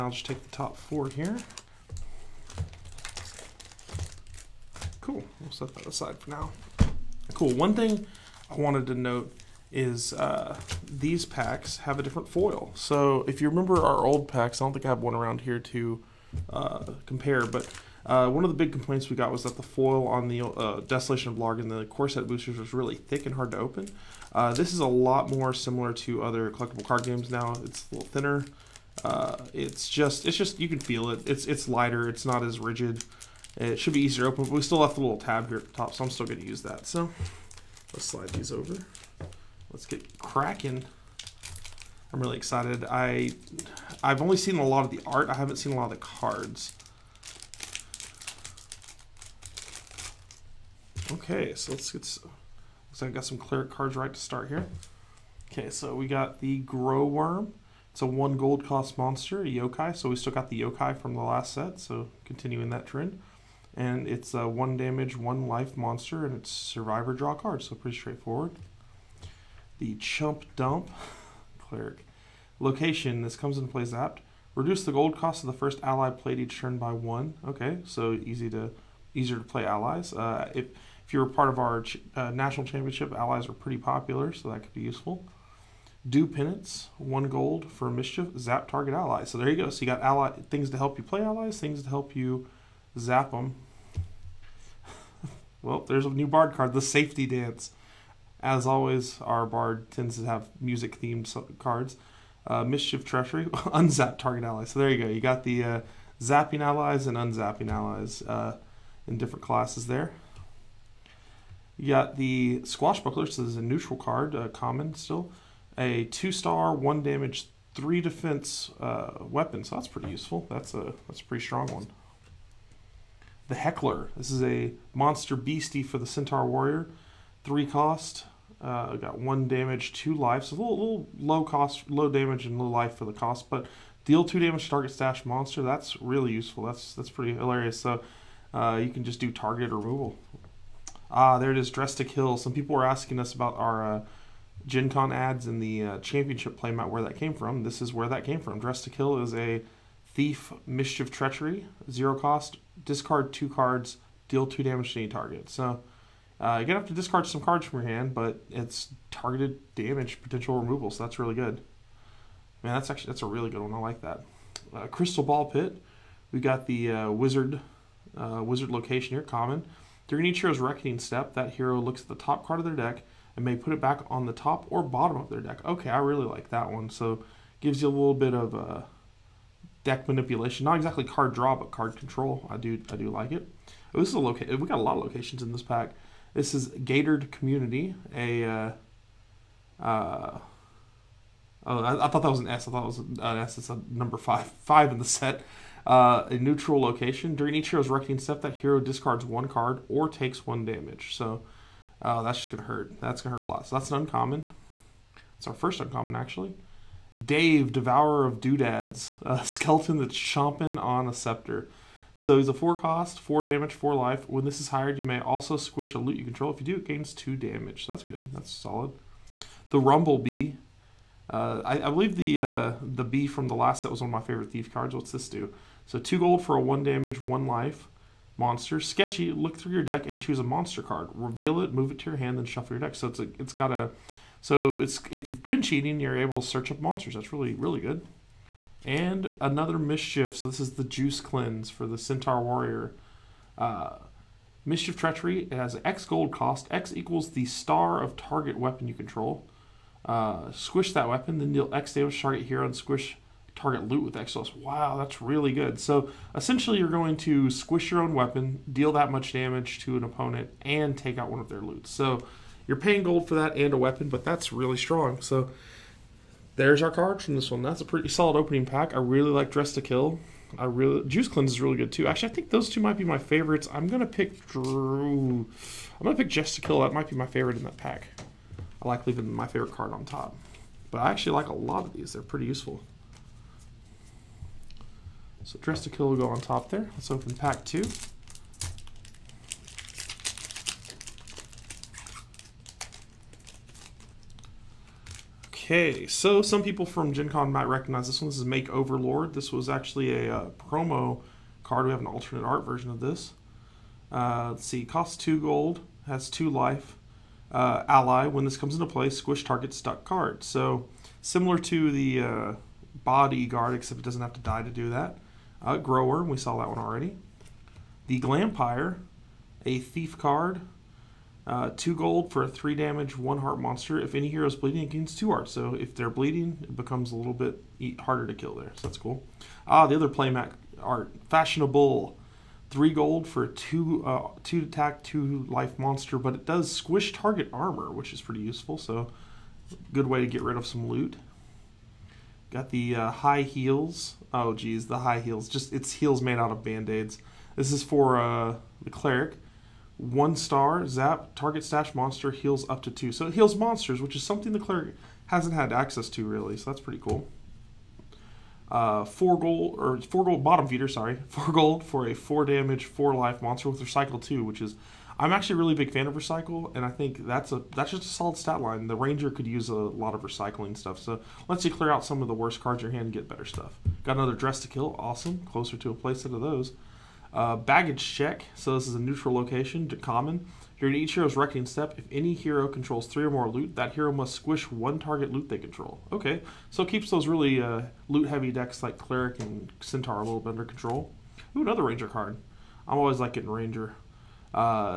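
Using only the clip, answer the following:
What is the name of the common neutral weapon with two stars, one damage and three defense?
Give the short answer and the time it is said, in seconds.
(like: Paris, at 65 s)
Squash Buckler, at 112 s.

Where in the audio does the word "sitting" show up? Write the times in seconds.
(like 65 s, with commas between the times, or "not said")
not said.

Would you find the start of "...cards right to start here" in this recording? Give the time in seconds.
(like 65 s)
53 s.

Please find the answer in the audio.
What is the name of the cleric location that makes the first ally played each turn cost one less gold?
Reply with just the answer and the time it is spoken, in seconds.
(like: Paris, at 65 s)
The Chump Dump, at 69 s.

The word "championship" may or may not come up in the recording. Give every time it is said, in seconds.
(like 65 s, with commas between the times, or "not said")
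82 s, 145 s.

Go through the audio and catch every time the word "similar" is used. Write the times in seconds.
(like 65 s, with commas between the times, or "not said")
25 s, 311 s.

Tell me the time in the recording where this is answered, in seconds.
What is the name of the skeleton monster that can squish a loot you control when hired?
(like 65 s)
207 s.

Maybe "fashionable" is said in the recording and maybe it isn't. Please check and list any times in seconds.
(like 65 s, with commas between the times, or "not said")
331 s.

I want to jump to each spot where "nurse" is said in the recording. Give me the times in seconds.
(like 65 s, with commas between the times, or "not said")
not said.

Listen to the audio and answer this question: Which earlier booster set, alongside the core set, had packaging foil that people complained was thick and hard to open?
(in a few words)
Desolation of Blarg.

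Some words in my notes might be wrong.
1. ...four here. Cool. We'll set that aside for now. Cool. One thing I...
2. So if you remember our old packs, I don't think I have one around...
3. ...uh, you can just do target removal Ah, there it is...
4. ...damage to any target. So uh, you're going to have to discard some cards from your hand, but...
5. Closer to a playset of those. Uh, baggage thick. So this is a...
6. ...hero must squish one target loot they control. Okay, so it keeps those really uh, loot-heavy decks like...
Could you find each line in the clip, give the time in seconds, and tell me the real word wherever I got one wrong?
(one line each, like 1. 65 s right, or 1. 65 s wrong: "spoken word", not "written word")
1. 0 s right
2. 12 s right
3. 138 s right
4. 154 s right
5. 375 s wrong: "check", not "thick"
6. 383 s right.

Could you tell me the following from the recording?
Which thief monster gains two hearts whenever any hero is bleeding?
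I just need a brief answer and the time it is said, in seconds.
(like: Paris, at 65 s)
The Glampire, at 318 s.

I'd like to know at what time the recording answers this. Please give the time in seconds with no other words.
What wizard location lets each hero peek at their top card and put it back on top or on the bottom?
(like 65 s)
164 s.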